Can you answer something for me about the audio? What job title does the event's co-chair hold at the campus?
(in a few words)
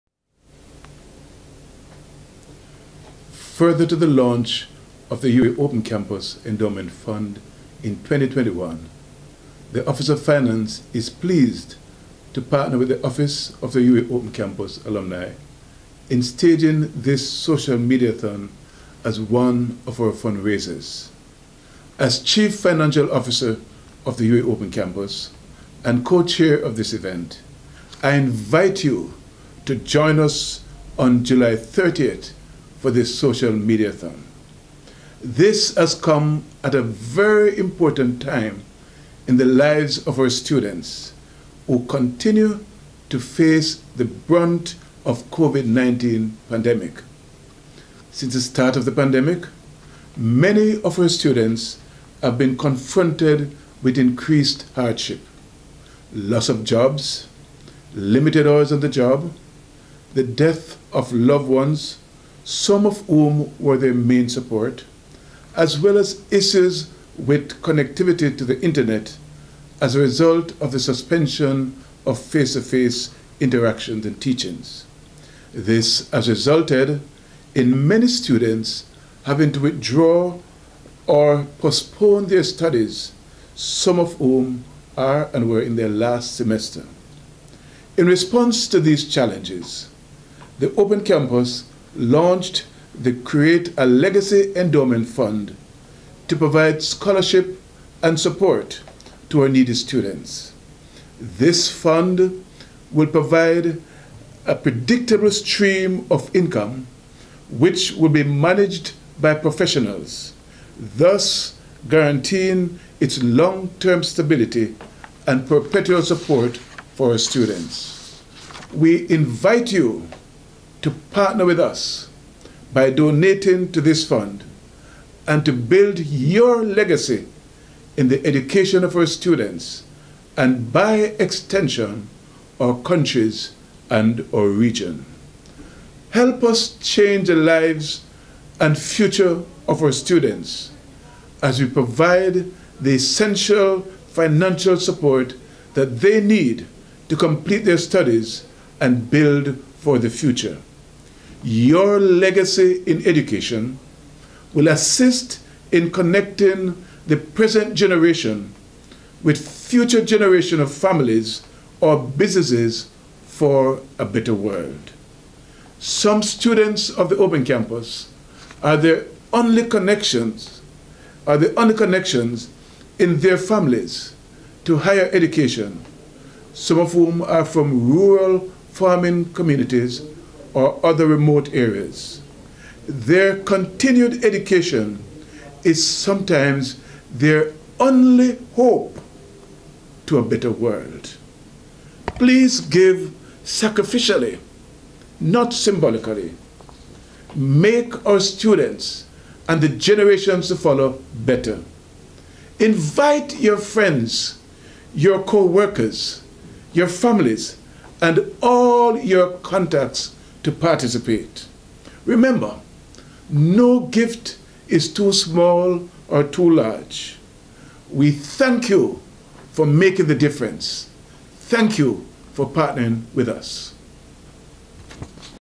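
Chief Financial Officer.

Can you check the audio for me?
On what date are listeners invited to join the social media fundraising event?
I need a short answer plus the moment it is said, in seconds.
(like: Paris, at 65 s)
July 30th, at 31 s.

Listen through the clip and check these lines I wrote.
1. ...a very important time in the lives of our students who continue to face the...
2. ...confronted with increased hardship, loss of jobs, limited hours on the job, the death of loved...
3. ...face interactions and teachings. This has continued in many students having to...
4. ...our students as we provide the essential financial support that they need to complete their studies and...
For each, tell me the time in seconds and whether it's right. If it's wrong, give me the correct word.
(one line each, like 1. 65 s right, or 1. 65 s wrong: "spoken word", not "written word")
1. 36 s right
2. 52 s right
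3. 72 s wrong: "resulted", not "continued"
4. 139 s right.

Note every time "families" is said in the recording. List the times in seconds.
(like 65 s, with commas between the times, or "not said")
160 s, 173 s, 206 s.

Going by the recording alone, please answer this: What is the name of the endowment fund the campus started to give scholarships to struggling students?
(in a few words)
Create a Legacy Endowment Fund.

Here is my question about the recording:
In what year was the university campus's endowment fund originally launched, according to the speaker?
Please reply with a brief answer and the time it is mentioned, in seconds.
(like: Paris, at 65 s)
2021, at 7 s.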